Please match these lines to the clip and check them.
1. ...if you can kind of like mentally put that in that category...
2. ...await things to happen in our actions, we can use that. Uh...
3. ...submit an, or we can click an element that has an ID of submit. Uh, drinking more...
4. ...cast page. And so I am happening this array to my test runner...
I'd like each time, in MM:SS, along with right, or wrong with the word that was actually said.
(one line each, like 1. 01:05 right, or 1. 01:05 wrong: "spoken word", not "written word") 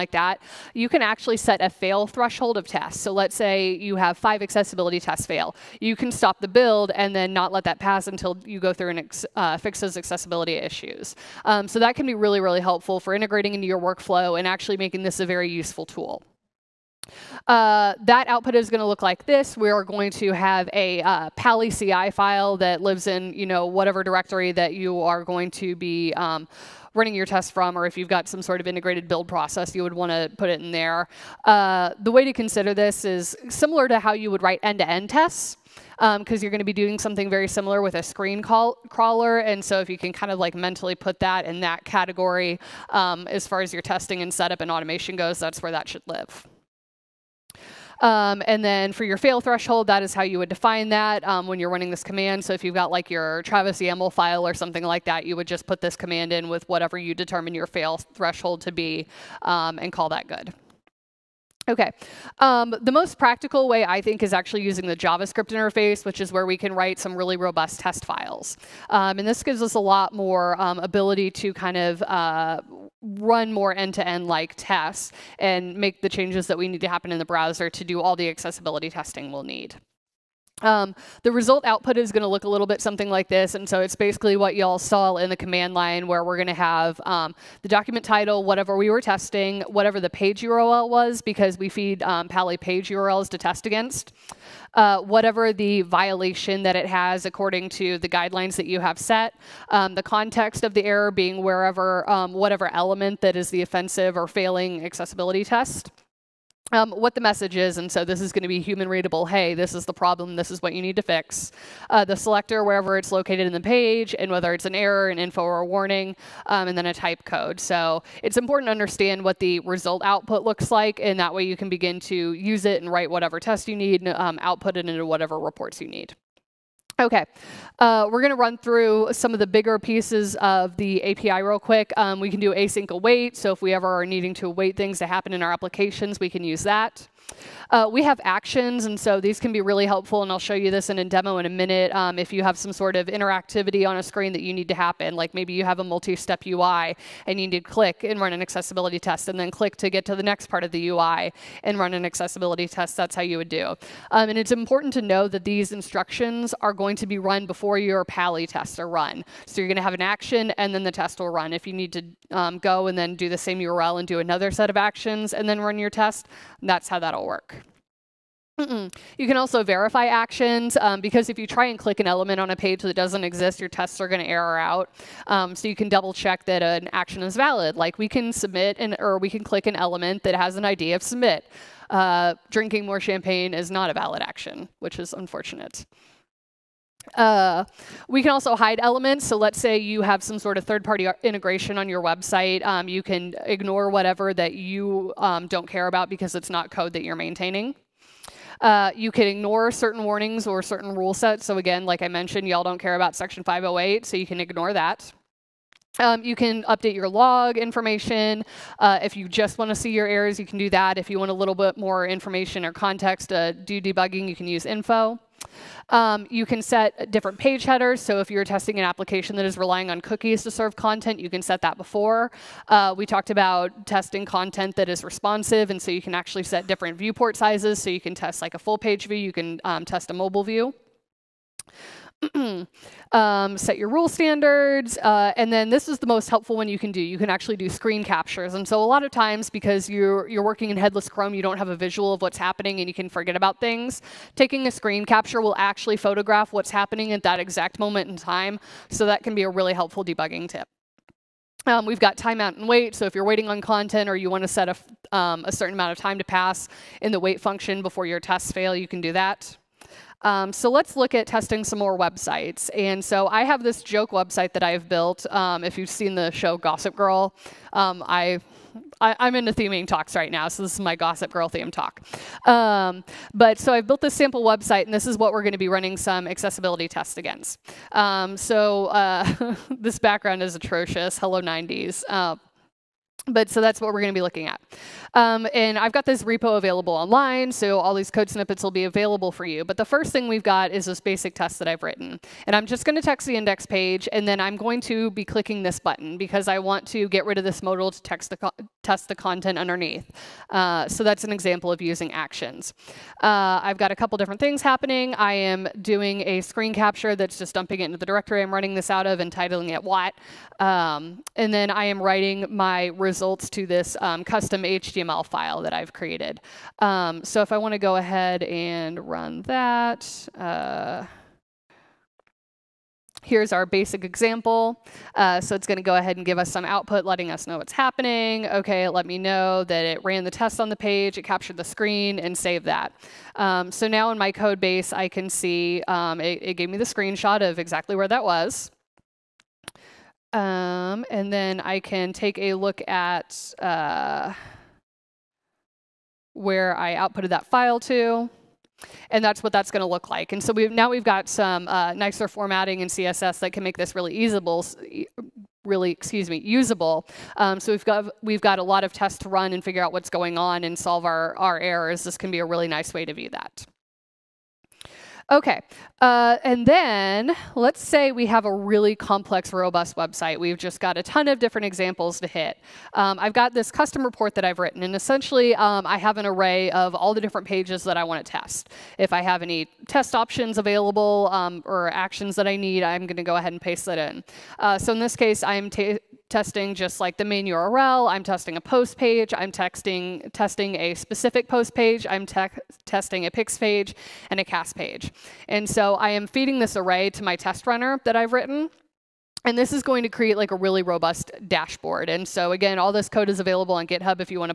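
1. 00:39 right
2. 02:14 wrong: "applications", not "actions"
3. 02:58 right
4. 06:34 wrong: "feeding", not "happening".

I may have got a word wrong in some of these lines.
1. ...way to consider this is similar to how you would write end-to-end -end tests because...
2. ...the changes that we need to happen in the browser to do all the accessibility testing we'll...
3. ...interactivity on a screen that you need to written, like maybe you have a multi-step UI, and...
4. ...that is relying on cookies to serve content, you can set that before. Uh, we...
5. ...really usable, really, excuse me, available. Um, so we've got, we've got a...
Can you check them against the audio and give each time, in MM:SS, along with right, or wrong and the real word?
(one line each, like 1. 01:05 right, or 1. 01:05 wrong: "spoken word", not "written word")
1. 00:32 right
2. 01:16 right
3. 02:23 wrong: "happen", not "written"
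4. 03:39 right
5. 05:53 wrong: "usable", not "available".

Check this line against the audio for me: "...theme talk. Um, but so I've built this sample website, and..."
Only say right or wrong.
right.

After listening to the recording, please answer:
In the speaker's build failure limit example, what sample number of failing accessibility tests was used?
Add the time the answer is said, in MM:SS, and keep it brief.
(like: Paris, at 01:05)
5, at 00:04.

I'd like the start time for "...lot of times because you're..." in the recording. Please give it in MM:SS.
03:58.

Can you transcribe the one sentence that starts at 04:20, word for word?
Um, so let's look at testing some more websites.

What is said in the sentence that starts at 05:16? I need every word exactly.
Um, so if I want to go ahead and run that, uh, Here's our basic example.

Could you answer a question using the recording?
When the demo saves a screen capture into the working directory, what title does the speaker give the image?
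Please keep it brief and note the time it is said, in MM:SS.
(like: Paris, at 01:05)
wat, at 05:09.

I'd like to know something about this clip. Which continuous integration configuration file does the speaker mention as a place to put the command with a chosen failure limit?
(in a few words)
Travis YAML file.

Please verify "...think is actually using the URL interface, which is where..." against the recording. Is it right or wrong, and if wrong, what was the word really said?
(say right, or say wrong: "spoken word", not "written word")
wrong: "JavaScript", not "URL".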